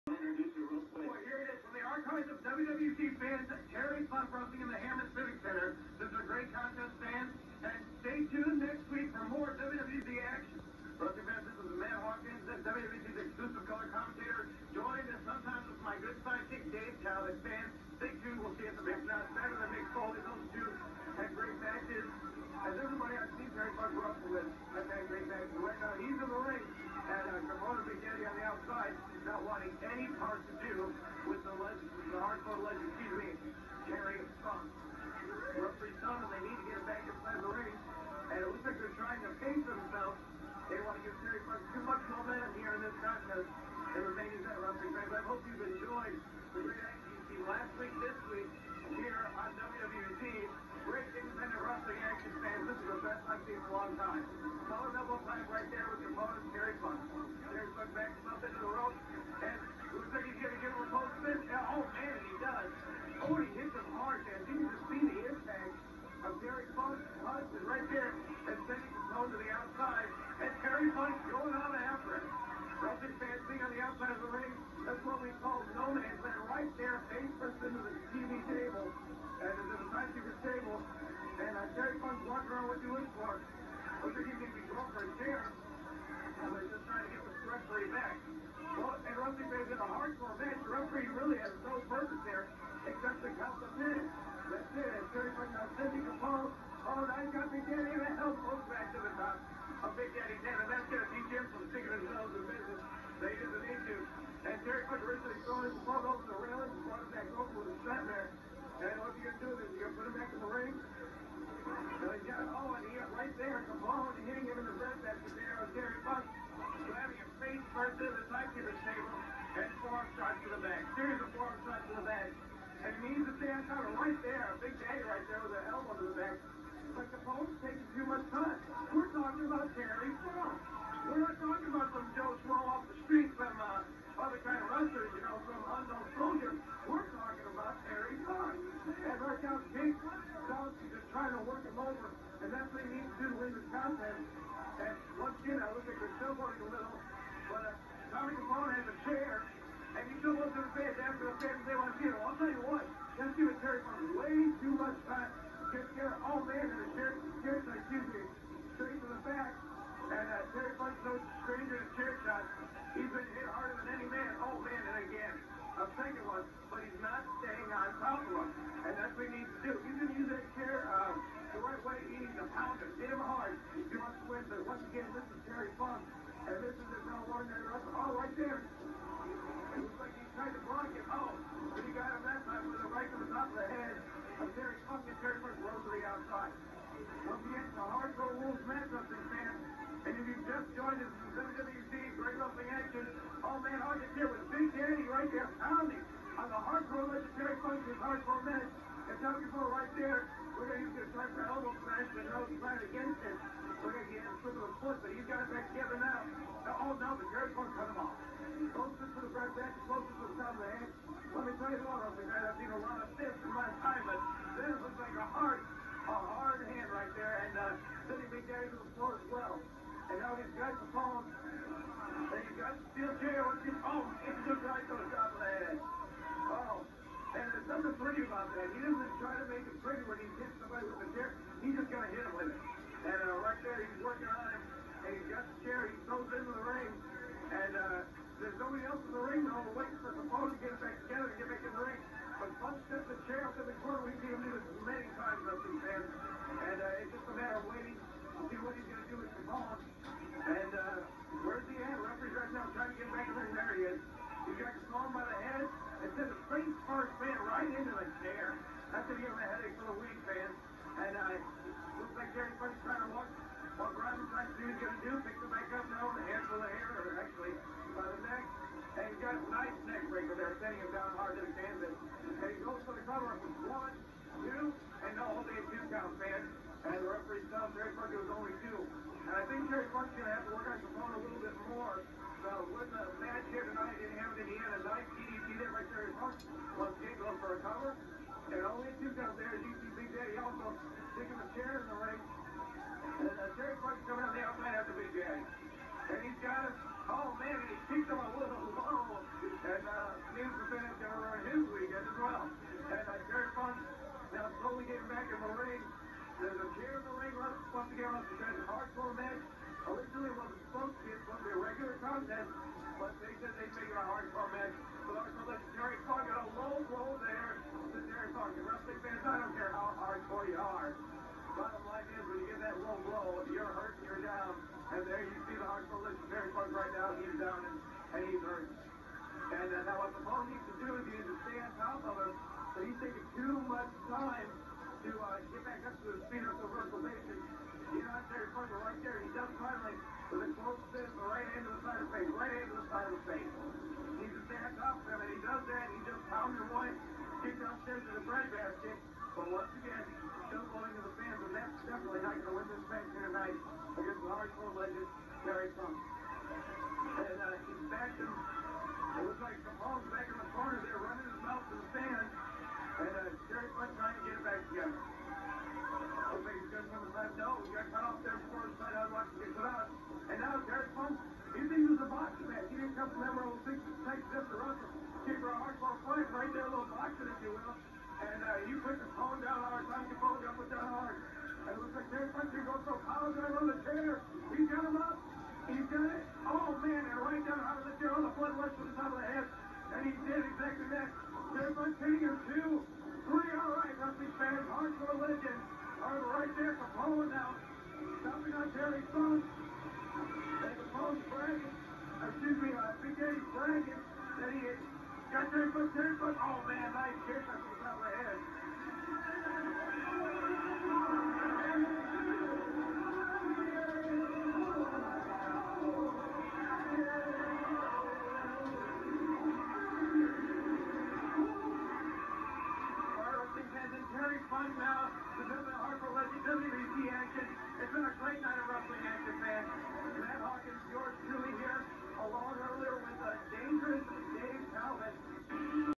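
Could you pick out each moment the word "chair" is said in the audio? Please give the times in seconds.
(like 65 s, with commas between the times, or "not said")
170 s, 291 s.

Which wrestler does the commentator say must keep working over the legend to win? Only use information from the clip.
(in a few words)
Jake Dawson.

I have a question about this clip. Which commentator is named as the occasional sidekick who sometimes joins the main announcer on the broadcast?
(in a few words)
Dave Talbot.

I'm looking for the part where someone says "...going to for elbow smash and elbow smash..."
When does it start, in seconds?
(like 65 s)
201 s.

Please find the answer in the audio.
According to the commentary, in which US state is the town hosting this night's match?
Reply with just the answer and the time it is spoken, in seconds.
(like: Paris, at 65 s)
Indiana, at 284 s.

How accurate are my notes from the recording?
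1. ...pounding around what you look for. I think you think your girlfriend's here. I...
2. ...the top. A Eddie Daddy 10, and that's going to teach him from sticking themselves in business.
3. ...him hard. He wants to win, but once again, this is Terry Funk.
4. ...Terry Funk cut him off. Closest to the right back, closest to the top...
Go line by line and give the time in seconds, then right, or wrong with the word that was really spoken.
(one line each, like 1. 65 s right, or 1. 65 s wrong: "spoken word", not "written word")
1. 82 s wrong: "walking", not "pounding"
2. 99 s wrong: "Big", not "Eddie"
3. 173 s right
4. 207 s right.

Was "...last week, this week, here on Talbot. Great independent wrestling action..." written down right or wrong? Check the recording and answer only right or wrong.
wrong.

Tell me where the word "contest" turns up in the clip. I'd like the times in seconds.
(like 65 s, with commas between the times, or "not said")
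6 s, 43 s, 143 s.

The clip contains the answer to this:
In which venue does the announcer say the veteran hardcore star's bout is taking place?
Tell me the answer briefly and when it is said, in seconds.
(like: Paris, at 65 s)
Hammond Civic Center, at 4 s.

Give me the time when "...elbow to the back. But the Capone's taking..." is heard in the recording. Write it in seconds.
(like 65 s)
125 s.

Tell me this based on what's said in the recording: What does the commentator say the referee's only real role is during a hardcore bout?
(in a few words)
count the minutes.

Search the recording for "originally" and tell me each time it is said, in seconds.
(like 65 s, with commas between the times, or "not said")
105 s.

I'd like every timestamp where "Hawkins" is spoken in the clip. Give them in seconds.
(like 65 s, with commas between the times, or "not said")
12 s, 430 s.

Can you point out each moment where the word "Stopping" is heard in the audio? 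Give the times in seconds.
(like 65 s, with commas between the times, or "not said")
398 s.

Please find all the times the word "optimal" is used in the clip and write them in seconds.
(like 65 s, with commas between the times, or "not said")
not said.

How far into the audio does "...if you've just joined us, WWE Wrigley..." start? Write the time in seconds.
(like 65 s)
190 s.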